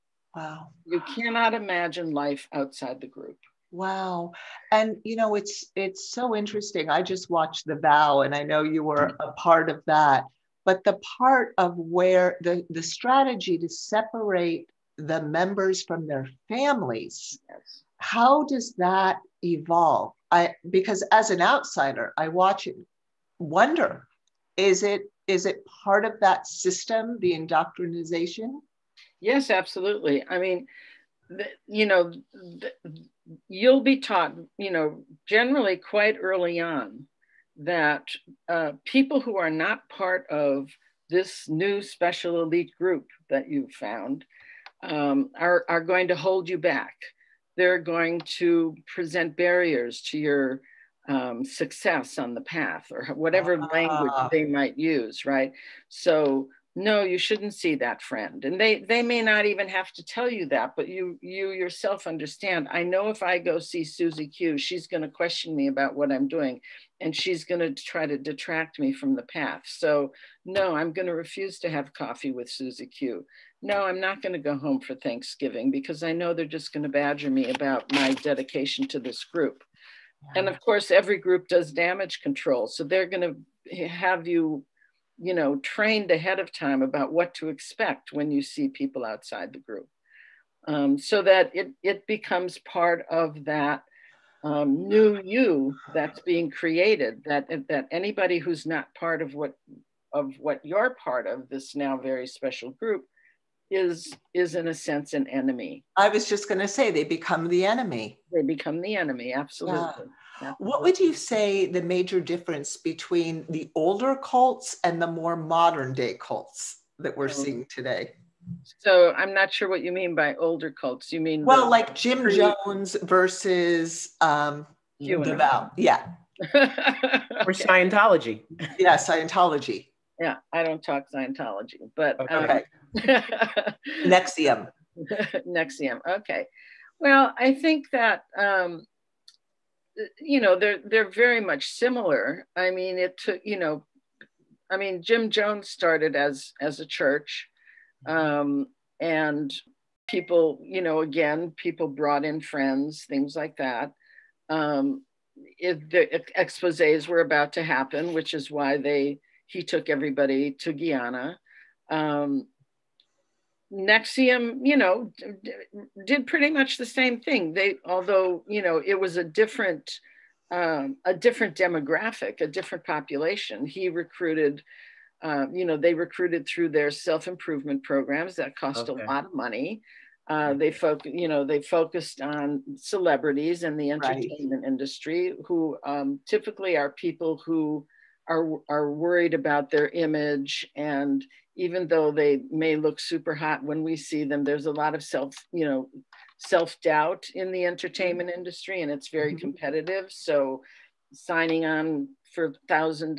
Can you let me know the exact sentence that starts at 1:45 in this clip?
I was just going to say they become the enemy.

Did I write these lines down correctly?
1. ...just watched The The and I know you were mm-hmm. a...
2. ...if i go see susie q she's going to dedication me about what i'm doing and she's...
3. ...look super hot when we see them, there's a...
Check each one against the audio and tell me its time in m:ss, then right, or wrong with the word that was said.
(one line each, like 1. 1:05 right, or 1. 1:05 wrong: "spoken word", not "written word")
1. 0:07 wrong: "Vow", not "The"
2. 1:03 wrong: "question", not "dedication"
3. 3:12 right.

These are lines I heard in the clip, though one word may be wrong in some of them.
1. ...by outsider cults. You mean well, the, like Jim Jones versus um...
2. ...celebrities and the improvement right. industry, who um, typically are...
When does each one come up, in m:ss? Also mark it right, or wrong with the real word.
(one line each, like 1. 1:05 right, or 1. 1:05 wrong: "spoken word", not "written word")
1. 2:00 wrong: "older", not "outsider"
2. 3:02 wrong: "entertainment", not "improvement".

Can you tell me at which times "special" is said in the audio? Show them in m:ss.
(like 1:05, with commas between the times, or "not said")
0:41, 1:42.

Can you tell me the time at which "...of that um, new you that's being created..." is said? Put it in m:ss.
1:33.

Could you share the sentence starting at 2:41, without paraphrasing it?
Um, NXIVM, you know, d- did pretty much the same thing.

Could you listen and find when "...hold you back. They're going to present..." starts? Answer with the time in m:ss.
0:46.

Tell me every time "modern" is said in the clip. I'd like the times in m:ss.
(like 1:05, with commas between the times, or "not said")
1:55.